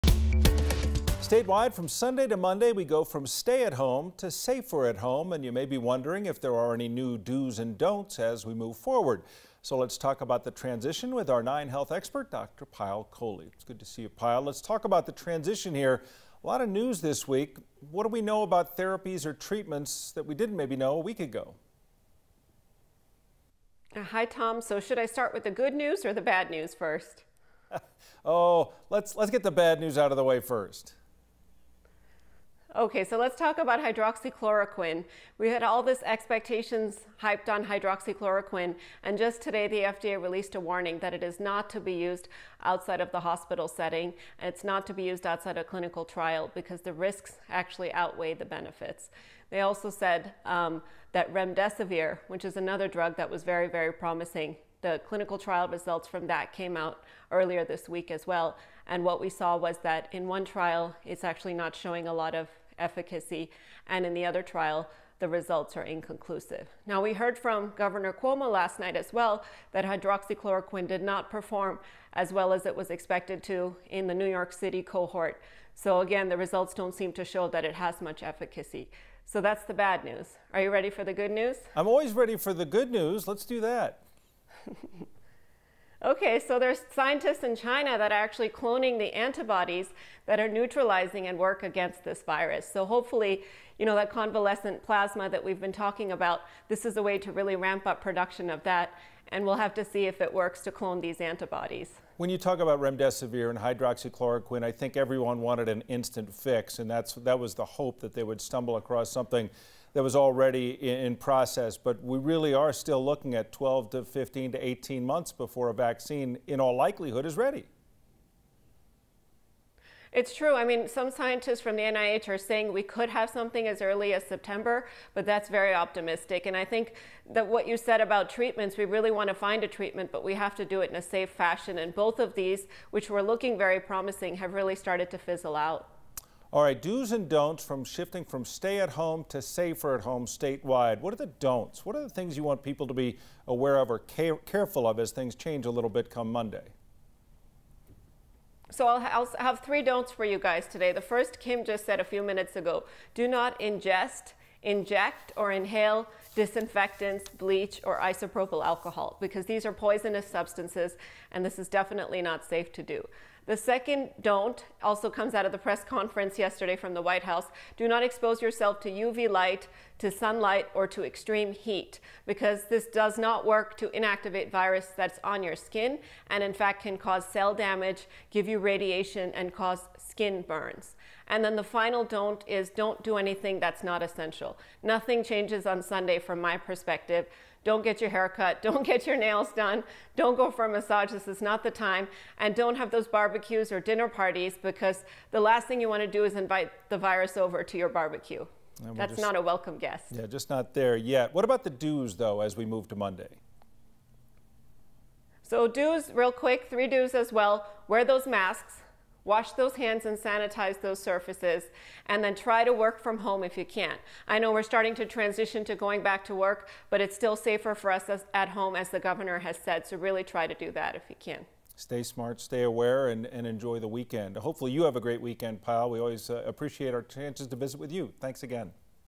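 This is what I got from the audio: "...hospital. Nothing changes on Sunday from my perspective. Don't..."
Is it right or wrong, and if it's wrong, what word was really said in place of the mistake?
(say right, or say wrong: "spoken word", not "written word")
wrong: "essential", not "hospital".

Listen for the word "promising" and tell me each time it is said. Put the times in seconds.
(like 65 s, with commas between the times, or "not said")
53 s, 133 s.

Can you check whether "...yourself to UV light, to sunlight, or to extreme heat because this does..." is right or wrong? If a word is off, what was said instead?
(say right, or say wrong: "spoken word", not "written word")
right.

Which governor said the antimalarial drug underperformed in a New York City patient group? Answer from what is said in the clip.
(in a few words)
Governor Cuomo.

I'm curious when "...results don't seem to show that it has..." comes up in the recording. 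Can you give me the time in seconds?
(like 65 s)
76 s.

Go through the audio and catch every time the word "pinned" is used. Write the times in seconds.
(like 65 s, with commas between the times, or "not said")
not said.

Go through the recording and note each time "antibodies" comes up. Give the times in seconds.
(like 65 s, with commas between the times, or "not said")
89 s, 101 s.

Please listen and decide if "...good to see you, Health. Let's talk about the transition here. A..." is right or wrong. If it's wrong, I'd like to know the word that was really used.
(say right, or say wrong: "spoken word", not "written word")
wrong: "Payal", not "Health".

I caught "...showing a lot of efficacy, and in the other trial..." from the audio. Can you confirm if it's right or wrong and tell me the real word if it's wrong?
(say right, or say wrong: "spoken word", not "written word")
right.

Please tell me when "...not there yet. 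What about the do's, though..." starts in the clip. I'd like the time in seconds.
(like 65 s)
200 s.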